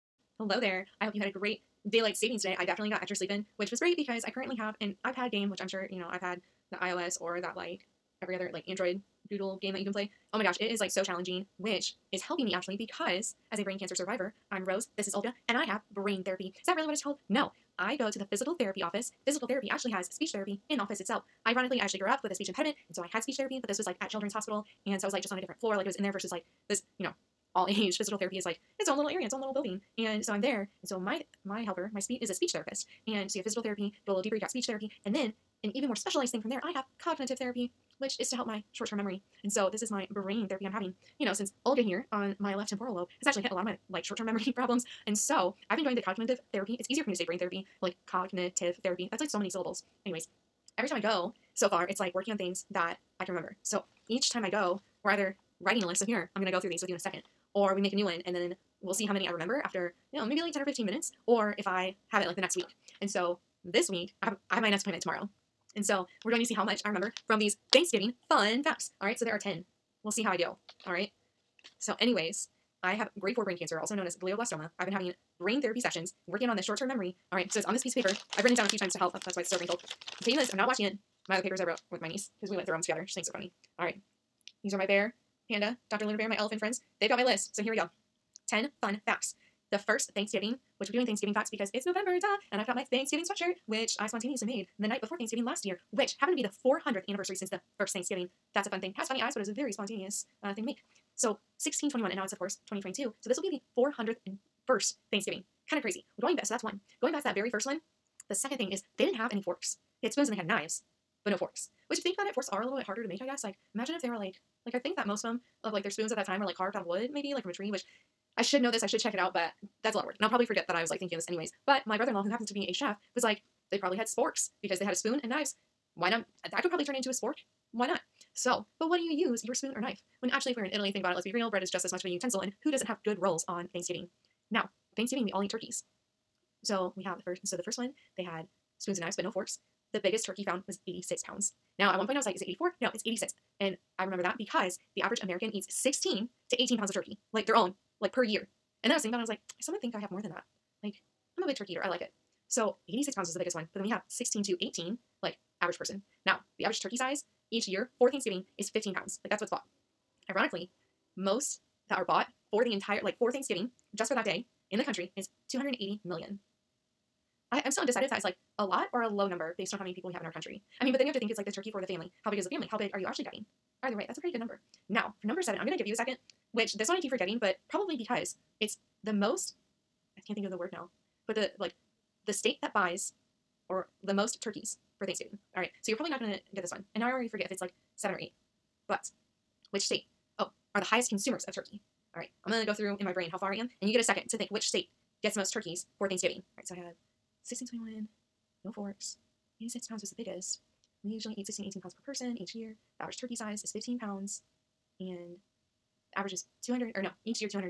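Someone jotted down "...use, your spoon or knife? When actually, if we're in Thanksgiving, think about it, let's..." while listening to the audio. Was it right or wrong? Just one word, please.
wrong.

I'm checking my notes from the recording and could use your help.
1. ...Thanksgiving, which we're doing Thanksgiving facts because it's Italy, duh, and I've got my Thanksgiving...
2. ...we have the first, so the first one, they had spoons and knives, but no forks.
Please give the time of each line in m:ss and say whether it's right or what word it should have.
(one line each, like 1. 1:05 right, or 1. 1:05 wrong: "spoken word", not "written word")
1. 1:30 wrong: "November", not "Italy"
2. 2:16 right.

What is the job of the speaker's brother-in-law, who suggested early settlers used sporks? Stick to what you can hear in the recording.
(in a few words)
Chef.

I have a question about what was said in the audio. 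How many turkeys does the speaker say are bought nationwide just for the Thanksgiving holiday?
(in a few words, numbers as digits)
280 million.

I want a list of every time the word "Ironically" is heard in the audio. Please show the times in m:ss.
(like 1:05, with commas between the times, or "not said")
0:21, 2:40.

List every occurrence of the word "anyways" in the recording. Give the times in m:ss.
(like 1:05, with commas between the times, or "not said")
0:50, 1:11, 2:01.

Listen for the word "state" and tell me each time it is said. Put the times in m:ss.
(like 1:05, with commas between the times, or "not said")
3:02, 3:09, 3:14.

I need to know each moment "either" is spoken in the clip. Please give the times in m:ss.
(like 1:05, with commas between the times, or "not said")
0:55, 2:53.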